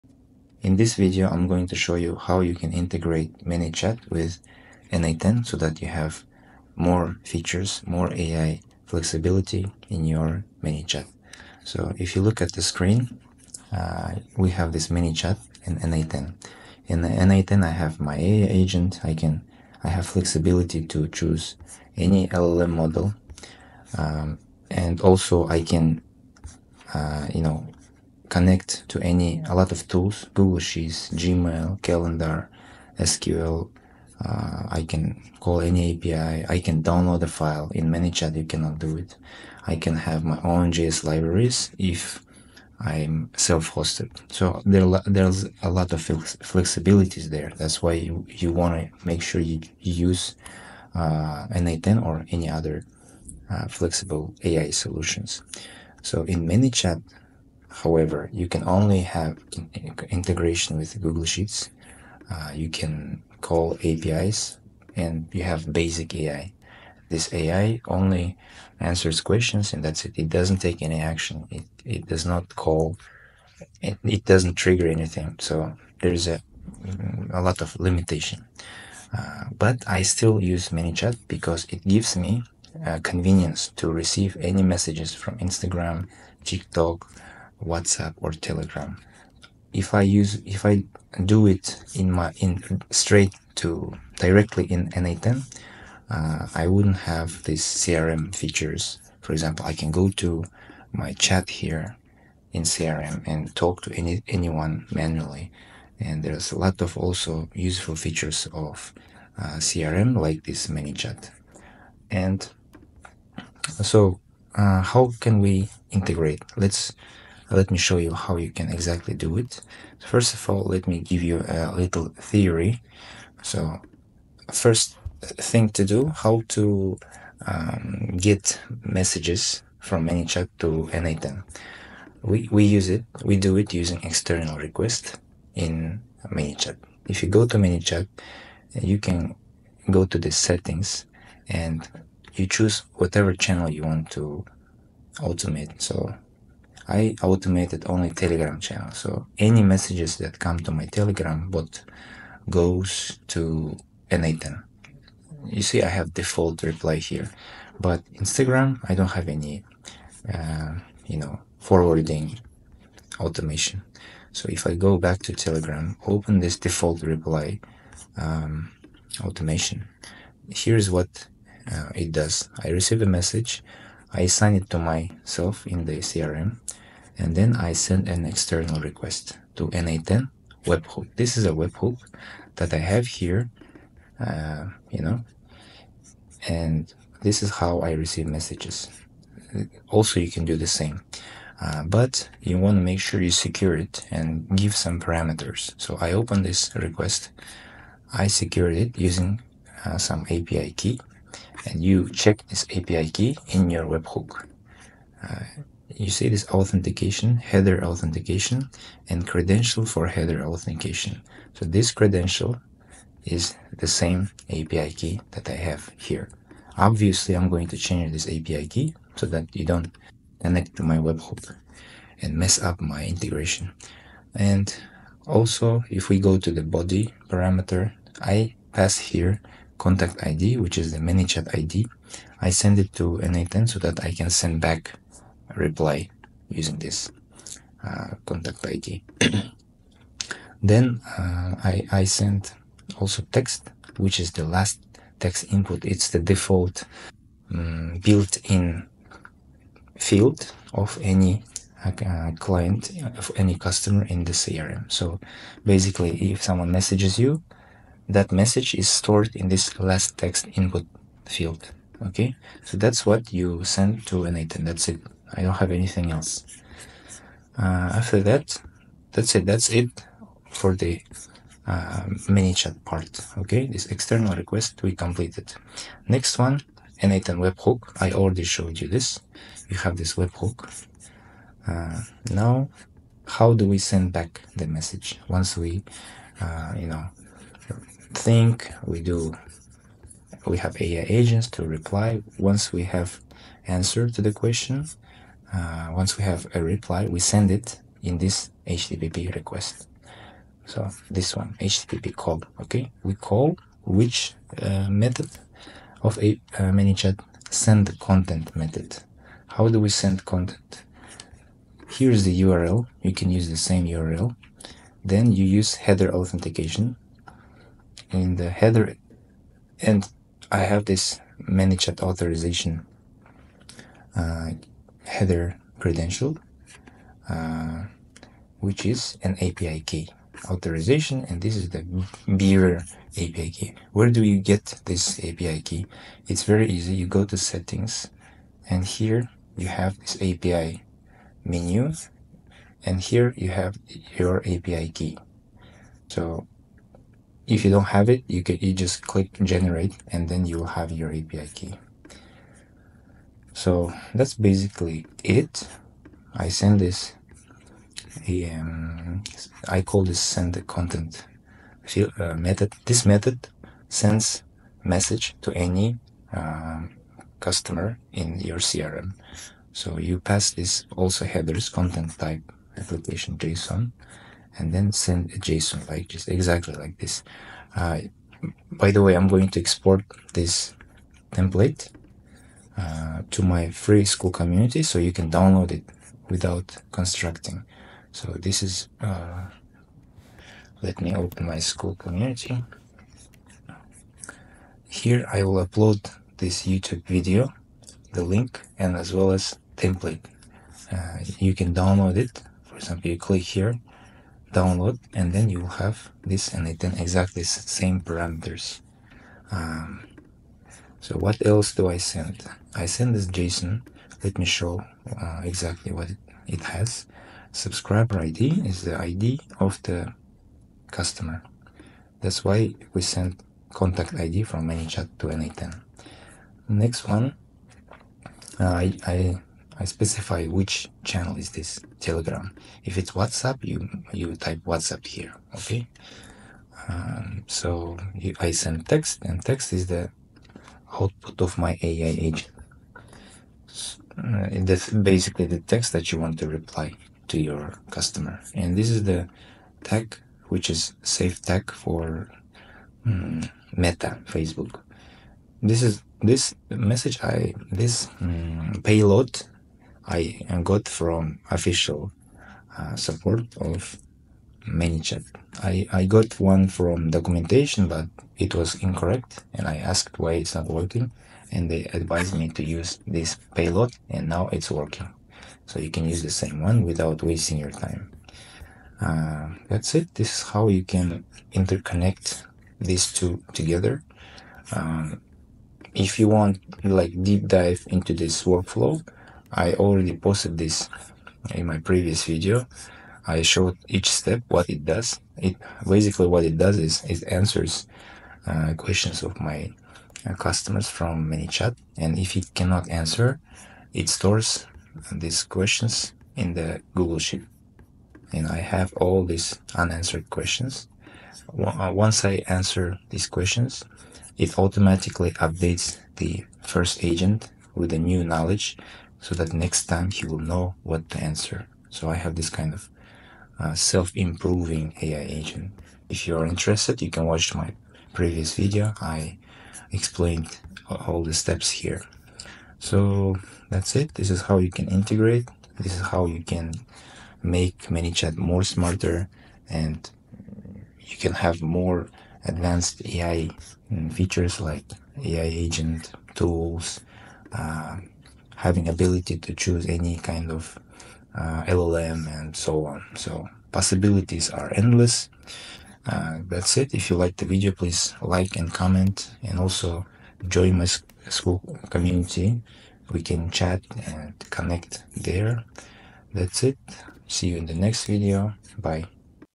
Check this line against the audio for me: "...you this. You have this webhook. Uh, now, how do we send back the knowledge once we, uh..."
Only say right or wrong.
wrong.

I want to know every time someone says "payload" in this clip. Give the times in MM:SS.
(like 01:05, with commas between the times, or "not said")
07:38, 07:53.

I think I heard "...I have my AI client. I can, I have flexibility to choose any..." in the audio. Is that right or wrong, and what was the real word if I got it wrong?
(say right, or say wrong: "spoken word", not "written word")
wrong: "agent", not "client".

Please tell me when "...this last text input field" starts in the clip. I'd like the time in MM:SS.
04:19.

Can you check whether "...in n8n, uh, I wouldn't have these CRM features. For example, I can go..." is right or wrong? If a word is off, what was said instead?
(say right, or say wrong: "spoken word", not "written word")
right.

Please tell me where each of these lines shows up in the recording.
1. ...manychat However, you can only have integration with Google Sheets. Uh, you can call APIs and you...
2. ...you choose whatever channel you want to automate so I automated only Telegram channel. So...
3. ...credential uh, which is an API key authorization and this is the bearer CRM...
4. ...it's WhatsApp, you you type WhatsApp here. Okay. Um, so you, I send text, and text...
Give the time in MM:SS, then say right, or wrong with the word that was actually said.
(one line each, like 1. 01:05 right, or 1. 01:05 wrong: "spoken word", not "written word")
1. 00:56 right
2. 02:22 right
3. 05:25 wrong: "API", not "CRM"
4. 07:12 right.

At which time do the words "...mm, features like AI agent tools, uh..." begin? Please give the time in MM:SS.
09:03.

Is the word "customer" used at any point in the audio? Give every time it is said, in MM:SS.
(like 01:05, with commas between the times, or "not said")
04:13, 06:07, 07:00, 07:27, 08:20.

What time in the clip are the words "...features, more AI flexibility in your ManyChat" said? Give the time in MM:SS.
00:07.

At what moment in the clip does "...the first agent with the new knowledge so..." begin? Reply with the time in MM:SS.
08:36.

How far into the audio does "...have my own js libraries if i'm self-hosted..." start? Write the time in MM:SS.
00:40.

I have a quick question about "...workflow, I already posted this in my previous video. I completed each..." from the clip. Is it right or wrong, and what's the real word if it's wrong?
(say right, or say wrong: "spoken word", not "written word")
wrong: "showed", not "completed".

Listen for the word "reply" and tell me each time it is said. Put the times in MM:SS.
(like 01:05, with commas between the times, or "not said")
02:36, 02:47, 03:55, 04:51, 04:56, 07:26.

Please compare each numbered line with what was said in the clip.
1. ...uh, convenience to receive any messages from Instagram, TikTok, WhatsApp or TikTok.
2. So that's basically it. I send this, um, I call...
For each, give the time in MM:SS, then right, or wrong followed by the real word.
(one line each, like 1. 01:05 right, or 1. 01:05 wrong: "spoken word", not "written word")
1. 01:22 wrong: "Telegram", not "TikTok"
2. 05:53 right.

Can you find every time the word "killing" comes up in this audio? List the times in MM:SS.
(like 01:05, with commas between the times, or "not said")
not said.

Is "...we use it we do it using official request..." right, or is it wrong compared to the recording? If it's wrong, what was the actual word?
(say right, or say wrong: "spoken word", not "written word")
wrong: "external", not "official".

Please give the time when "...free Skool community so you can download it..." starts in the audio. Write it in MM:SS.
06:23.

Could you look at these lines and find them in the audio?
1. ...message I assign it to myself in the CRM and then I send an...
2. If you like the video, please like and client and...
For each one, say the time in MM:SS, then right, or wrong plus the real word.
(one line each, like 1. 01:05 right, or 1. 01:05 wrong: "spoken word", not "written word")
1. 02:53 right
2. 09:16 wrong: "comment", not "client".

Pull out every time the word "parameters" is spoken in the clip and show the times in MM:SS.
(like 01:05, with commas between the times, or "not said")
03:14, 03:47, 06:48.